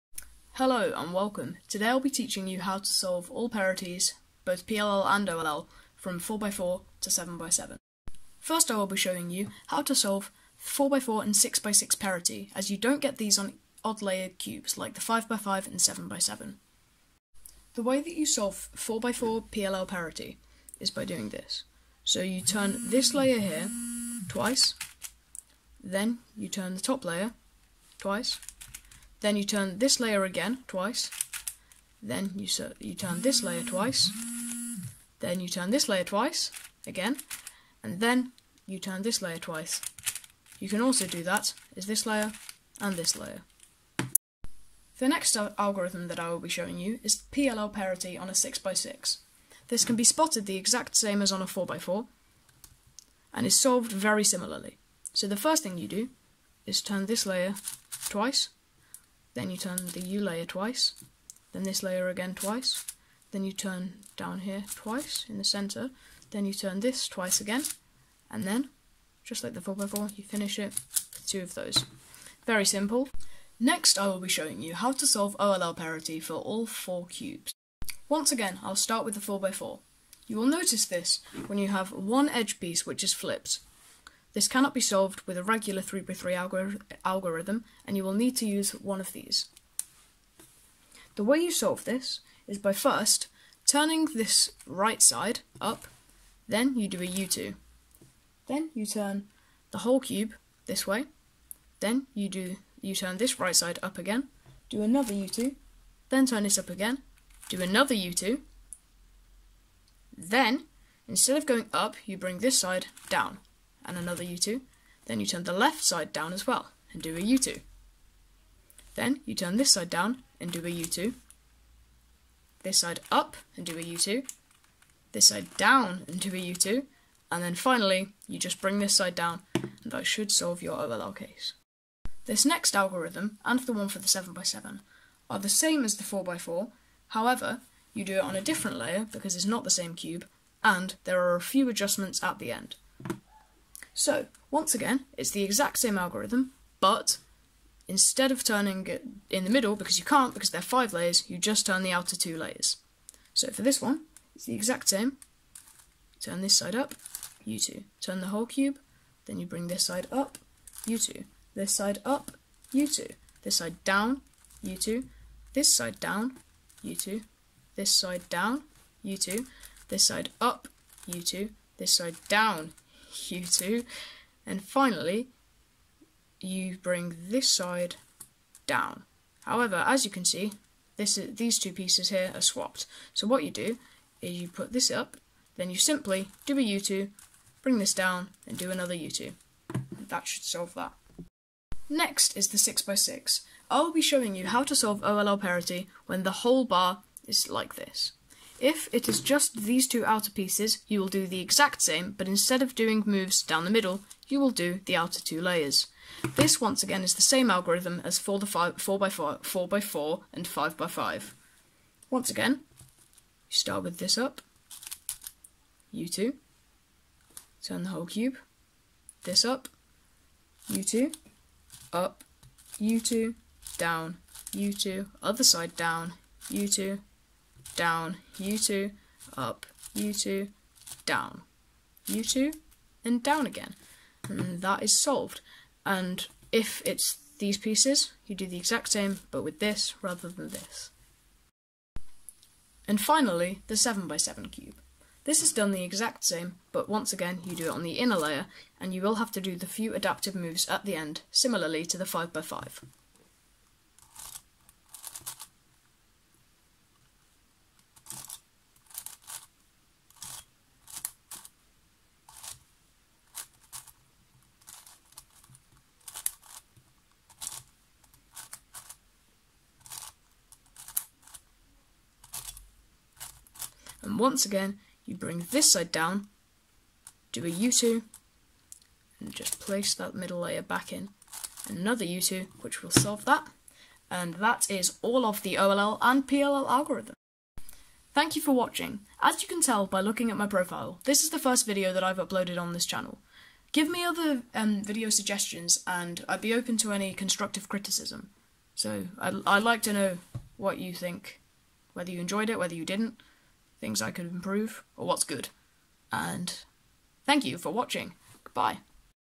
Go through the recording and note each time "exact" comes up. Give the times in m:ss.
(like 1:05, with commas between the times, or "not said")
0:50, 2:25, 2:34, 3:21, 3:58, 4:05.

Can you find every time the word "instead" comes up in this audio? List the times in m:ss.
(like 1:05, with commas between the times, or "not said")
1:51, 2:27, 3:22.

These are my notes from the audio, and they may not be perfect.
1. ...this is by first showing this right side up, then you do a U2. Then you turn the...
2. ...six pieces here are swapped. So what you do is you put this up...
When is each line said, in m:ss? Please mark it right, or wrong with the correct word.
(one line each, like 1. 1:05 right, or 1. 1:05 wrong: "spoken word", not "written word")
1. 1:31 wrong: "turning", not "showing"
2. 3:01 wrong: "two", not "six".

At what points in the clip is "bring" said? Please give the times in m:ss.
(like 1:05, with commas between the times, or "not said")
1:52, 2:08, 2:39, 2:56, 3:07, 4:35.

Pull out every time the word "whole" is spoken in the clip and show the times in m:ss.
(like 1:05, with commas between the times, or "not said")
1:39, 2:38, 3:16, 3:37.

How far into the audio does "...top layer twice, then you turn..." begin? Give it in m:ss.
0:26.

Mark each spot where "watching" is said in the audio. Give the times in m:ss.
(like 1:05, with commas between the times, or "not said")
4:48, 5:07.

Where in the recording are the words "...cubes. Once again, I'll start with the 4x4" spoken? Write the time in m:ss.
1:17.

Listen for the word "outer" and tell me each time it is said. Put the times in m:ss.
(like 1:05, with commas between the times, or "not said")
2:31, 3:20, 3:24.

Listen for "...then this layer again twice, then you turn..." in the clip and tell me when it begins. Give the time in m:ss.
1:01.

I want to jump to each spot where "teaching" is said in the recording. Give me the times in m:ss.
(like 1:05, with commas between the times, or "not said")
0:02.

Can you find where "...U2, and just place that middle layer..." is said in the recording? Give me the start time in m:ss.
4:37.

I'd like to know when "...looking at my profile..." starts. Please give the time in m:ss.
4:50.